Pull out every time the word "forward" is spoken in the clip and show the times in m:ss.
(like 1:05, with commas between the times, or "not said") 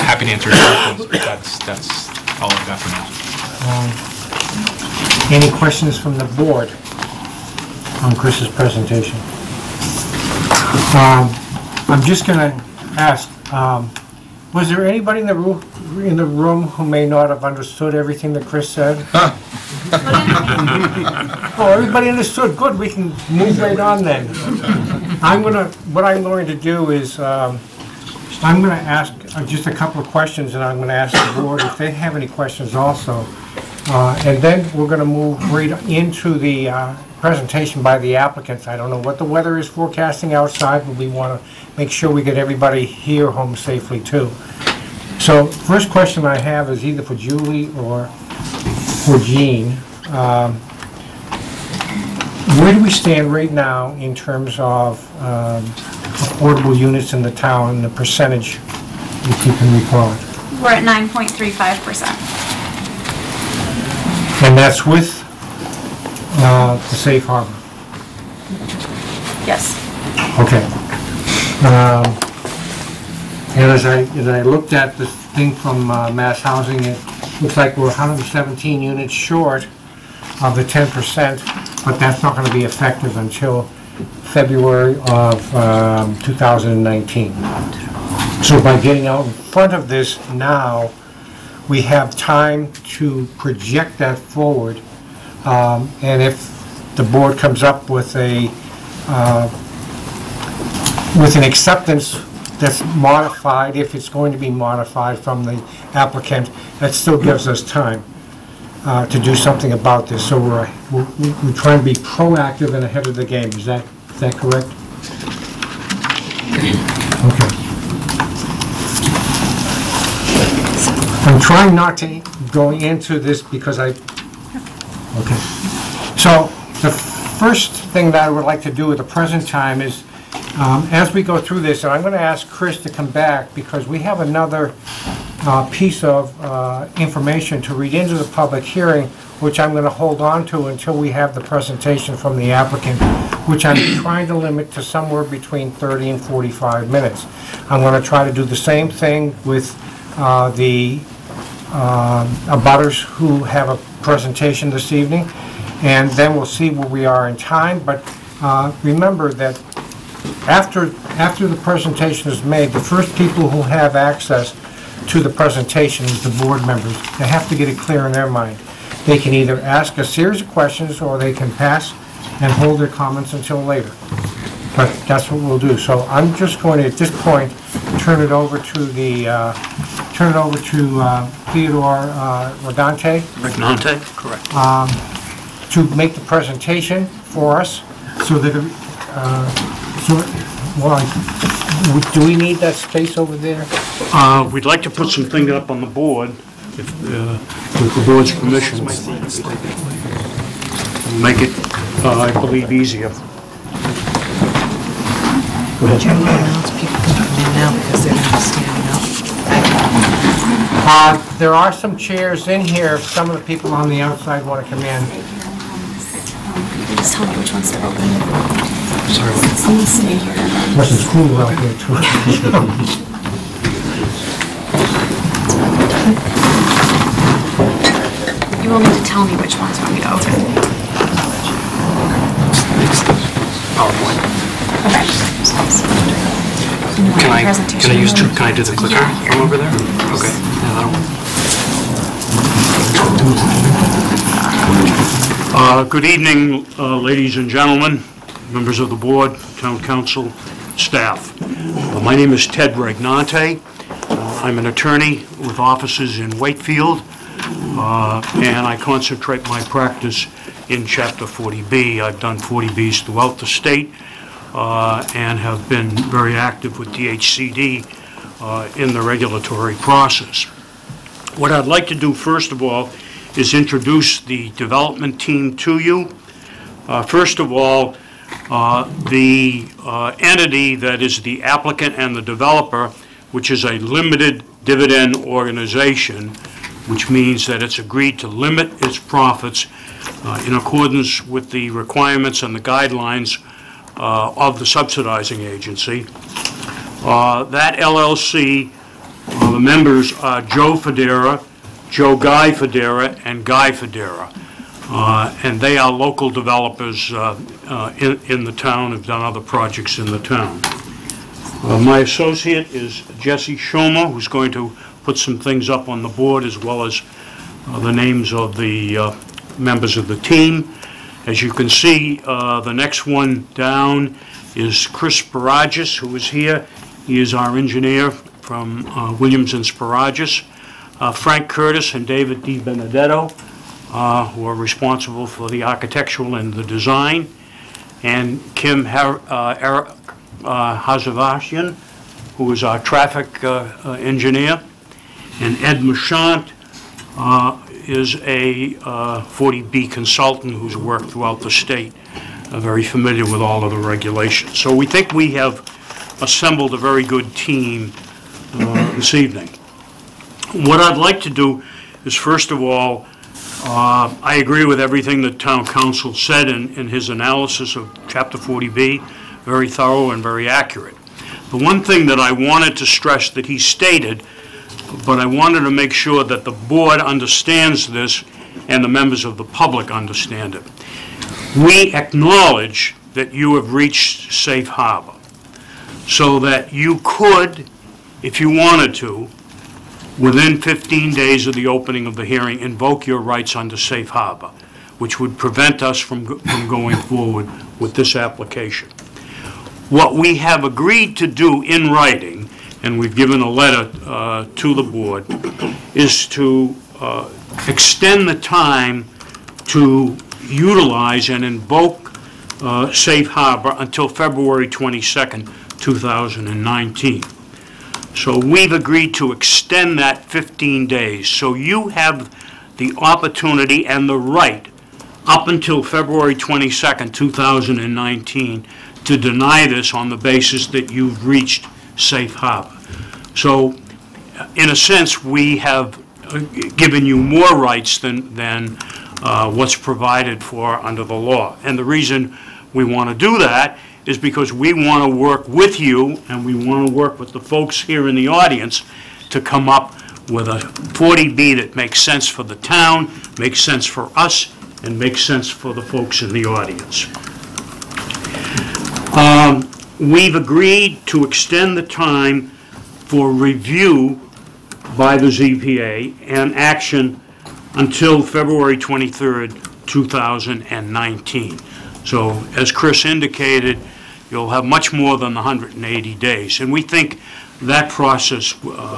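1:34, 6:36.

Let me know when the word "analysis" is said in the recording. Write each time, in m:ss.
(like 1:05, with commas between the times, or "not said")
6:07.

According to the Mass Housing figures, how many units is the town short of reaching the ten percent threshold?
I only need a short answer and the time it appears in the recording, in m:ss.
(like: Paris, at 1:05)
117, at 1:17.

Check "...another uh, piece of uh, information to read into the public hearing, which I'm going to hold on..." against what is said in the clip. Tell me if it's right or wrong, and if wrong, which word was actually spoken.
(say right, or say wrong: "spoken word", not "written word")
right.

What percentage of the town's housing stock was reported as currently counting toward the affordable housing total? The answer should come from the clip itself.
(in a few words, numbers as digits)
9.35%.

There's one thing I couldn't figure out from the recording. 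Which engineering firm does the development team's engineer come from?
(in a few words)
Williams and Sparages.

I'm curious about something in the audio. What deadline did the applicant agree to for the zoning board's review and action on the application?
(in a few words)
February 23rd, 2019.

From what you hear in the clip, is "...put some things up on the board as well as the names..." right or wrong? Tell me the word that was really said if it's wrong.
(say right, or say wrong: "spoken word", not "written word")
right.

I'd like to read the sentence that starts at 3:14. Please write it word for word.
Uh, We'd like to put something up on the board, if, uh, with the board's permission.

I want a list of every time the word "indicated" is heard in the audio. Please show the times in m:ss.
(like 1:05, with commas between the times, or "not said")
7:53.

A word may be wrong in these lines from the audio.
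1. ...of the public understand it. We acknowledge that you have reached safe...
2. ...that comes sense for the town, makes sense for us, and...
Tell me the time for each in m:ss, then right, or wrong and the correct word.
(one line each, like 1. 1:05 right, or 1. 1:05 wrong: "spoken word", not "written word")
1. 6:19 right
2. 7:31 wrong: "makes", not "comes".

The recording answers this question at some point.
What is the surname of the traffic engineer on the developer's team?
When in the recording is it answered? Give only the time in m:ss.
5:40.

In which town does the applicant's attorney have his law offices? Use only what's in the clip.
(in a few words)
Wakefield.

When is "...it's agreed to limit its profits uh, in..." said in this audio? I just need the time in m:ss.
4:47.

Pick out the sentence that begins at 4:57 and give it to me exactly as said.
Uh, that LLC, uh, the members are Joe Federa, Joe Guy Federa, and Guy Federa.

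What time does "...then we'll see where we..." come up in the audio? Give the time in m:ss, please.
2:36.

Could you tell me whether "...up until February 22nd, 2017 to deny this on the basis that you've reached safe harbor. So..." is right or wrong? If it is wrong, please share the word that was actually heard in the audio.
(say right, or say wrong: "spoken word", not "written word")
wrong: "2019", not "2017".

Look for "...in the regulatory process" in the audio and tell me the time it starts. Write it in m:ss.
4:28.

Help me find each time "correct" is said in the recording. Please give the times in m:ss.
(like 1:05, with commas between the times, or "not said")
1:54, 3:04.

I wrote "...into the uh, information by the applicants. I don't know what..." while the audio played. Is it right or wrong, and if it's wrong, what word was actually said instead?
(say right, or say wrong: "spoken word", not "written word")
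wrong: "presentation", not "information".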